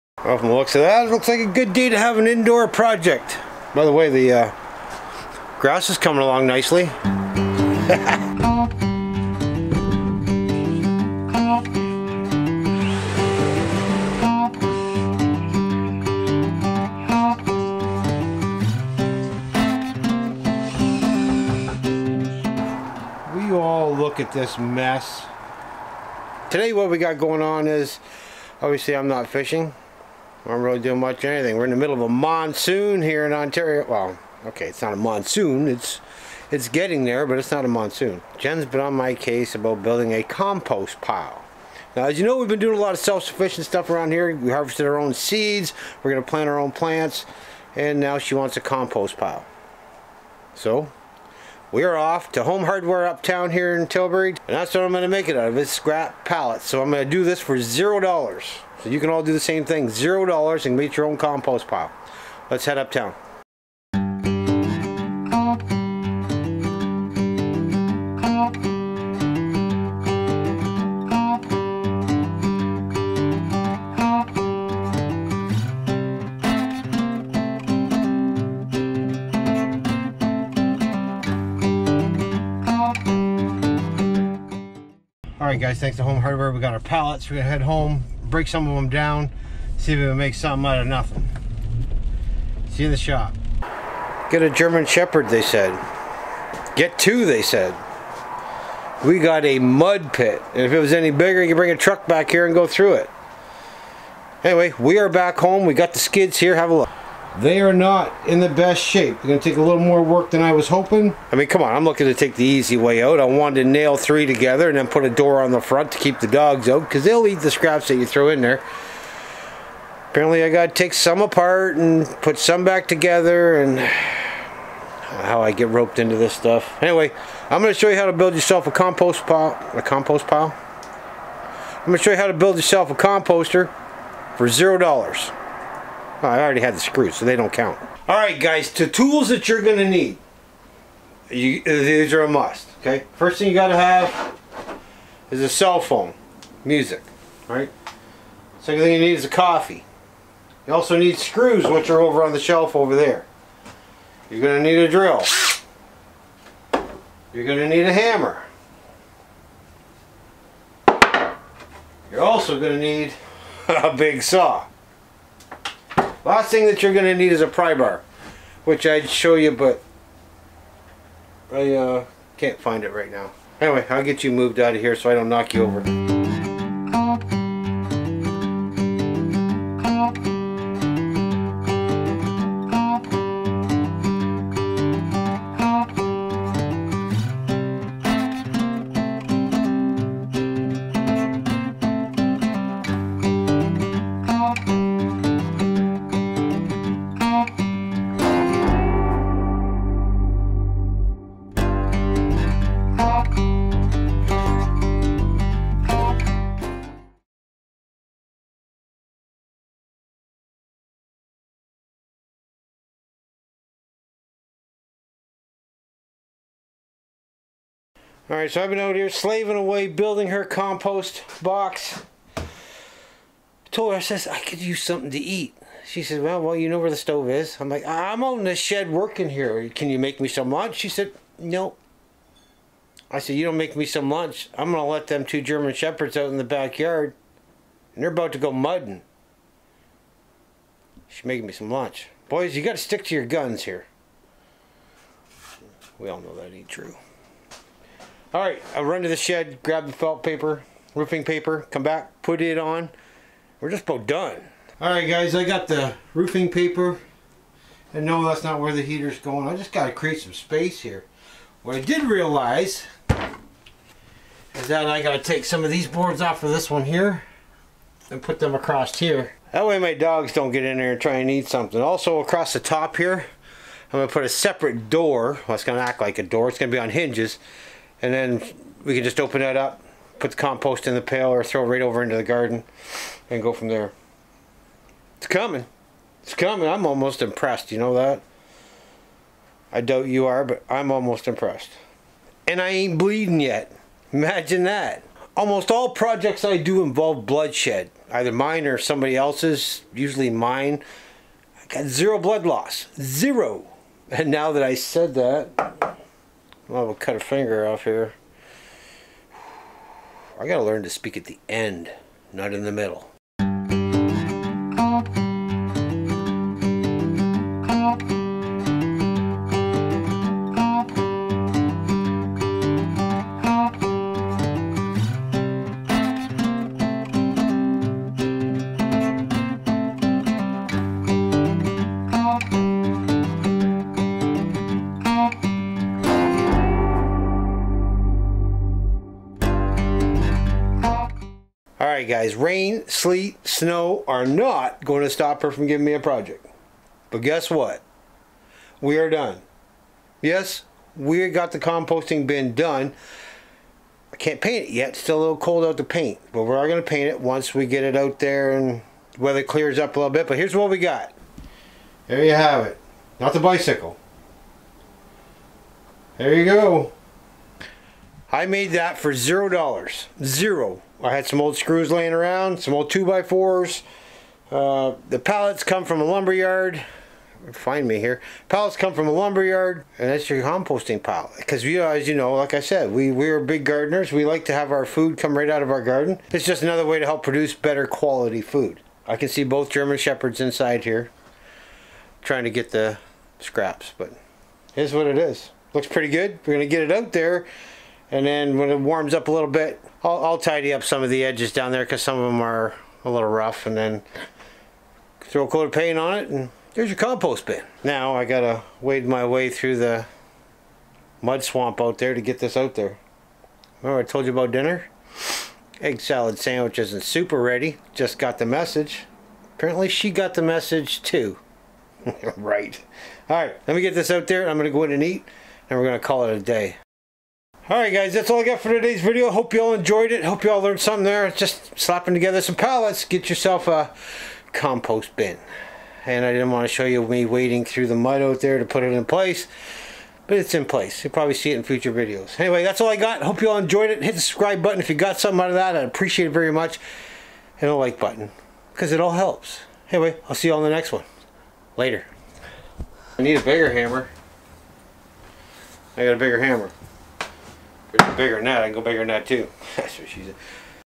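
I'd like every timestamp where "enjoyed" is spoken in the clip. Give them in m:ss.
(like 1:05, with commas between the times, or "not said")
7:09, 7:23.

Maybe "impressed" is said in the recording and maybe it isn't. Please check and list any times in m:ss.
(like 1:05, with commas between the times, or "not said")
4:47, 4:51.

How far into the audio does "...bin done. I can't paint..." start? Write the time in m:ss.
5:52.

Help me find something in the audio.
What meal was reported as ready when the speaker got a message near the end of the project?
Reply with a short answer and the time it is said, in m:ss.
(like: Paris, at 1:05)
egg salad sandwich, at 6:55.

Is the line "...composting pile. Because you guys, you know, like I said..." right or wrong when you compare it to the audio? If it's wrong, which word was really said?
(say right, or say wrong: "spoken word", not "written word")
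right.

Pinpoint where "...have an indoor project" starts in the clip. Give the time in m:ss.
0:01.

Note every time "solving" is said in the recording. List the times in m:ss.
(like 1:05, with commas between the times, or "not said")
not said.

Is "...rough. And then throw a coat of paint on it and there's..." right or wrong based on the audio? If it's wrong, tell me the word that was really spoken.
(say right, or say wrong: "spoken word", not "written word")
right.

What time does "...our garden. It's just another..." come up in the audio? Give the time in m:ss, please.
6:25.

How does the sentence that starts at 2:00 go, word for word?
Apparently, I got to take some apart and put some back together and how I get roped into this stuff.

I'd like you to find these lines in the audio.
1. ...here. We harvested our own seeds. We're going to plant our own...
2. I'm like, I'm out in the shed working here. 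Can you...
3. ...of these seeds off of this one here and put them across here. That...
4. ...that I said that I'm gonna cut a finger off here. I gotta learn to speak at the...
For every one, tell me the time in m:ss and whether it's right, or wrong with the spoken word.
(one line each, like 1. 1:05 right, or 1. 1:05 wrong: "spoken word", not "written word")
1. 0:44 right
2. 3:47 right
3. 4:25 wrong: "boards", not "seeds"
4. 5:04 right.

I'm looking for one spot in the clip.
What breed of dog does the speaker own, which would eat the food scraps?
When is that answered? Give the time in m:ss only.
1:34.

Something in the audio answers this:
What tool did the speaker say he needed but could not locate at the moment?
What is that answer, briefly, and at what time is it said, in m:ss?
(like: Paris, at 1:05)
pry bar, at 2:47.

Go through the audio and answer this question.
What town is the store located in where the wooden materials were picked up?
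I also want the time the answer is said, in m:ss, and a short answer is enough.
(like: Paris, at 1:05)
Tilbury, at 0:53.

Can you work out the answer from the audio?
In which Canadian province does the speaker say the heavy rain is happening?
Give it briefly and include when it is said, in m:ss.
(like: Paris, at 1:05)
Ontario, at 0:33.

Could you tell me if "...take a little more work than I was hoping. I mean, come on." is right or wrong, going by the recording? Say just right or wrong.
right.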